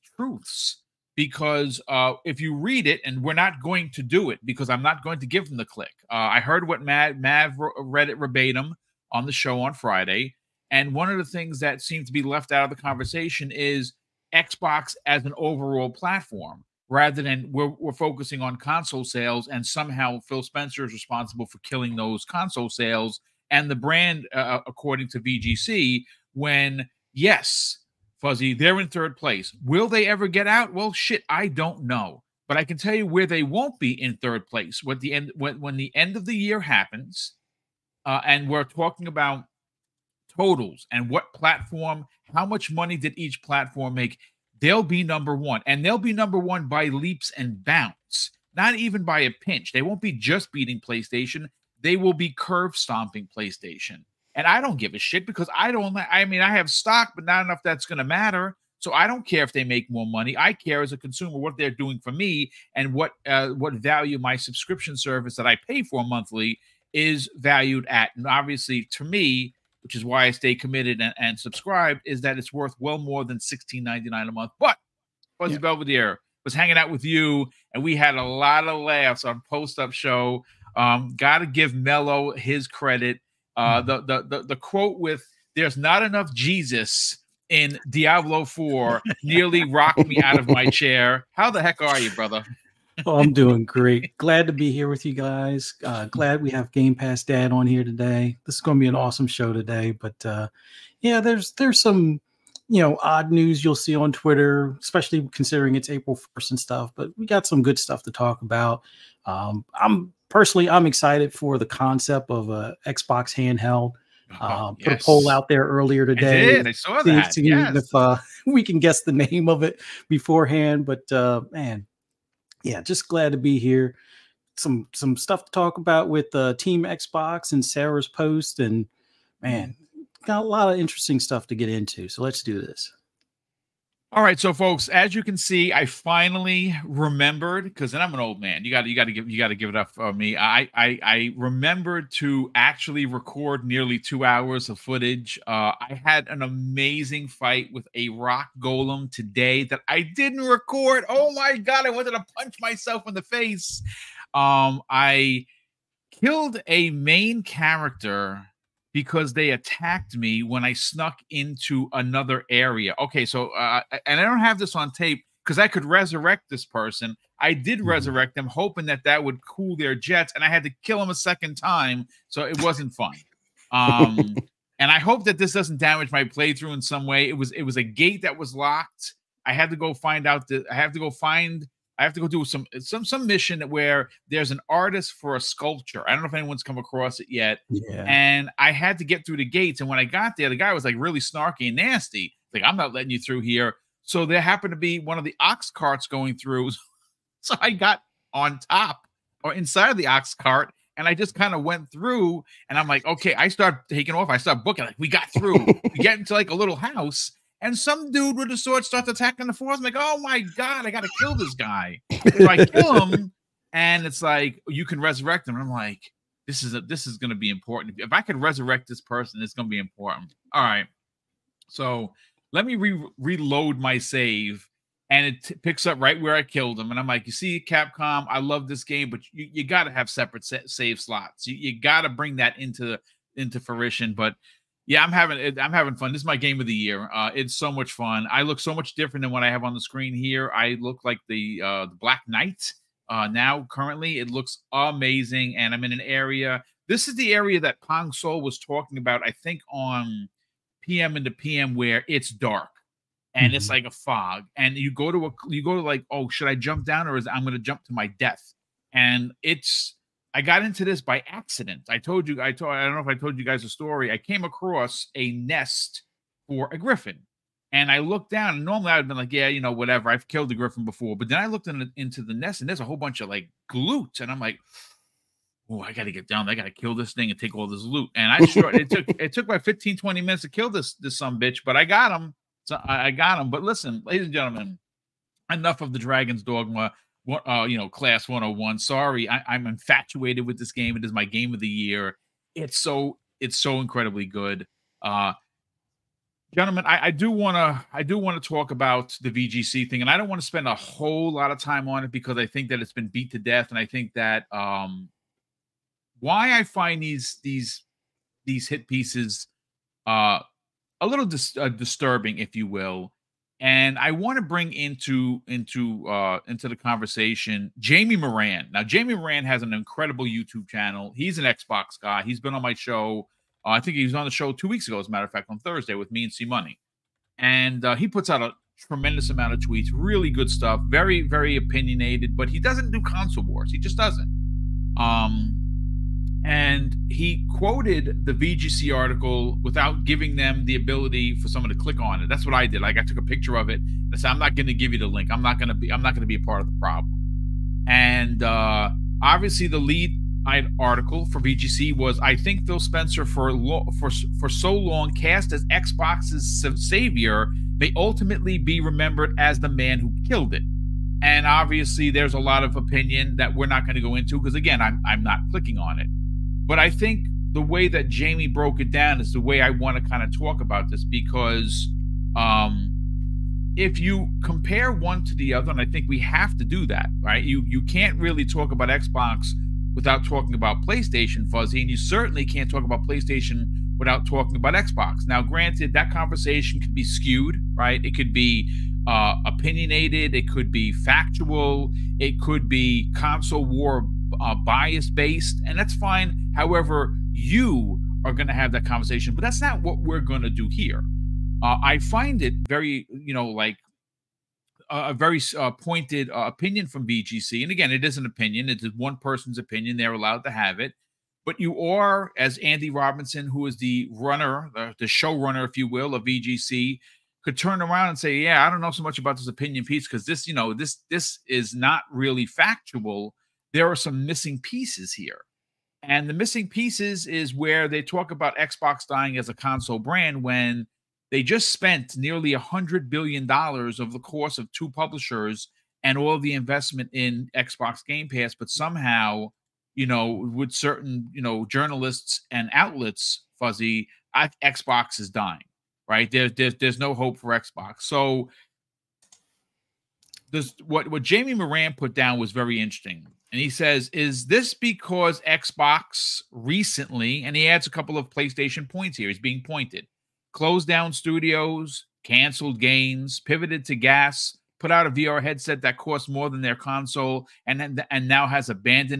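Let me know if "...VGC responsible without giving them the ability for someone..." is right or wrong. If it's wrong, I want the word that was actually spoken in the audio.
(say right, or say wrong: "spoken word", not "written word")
wrong: "article", not "responsible".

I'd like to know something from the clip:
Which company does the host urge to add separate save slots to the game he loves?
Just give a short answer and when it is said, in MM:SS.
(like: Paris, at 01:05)
Capcom, at 03:47.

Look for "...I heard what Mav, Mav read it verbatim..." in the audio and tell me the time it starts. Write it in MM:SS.
00:06.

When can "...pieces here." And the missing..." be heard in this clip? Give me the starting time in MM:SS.
07:04.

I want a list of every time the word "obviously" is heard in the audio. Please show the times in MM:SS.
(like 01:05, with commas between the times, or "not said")
01:08, 05:49, 06:01.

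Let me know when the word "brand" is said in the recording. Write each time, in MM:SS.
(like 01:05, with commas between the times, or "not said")
00:23, 07:09.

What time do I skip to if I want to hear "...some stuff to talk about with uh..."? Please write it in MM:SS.
02:04.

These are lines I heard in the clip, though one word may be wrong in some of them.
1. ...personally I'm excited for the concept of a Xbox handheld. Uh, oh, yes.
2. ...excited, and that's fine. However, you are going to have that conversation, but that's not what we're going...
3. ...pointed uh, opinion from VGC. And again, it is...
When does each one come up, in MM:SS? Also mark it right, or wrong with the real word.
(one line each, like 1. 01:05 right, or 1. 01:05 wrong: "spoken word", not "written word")
1. 01:50 right
2. 06:35 wrong: "based", not "excited"
3. 06:45 right.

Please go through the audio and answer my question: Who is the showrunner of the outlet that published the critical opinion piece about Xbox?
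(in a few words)
Andy Robinson.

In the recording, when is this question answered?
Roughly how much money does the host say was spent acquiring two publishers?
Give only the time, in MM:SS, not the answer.
07:12.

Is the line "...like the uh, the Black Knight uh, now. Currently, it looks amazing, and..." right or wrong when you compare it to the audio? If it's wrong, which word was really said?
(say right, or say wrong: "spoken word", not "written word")
right.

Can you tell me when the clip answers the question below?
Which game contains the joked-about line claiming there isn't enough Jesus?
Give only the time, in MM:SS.
01:27.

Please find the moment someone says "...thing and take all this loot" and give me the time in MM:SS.
04:37.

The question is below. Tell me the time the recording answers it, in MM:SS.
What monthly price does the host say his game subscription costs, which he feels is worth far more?
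01:13.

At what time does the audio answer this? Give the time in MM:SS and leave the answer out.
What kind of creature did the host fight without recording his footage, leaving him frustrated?
02:28.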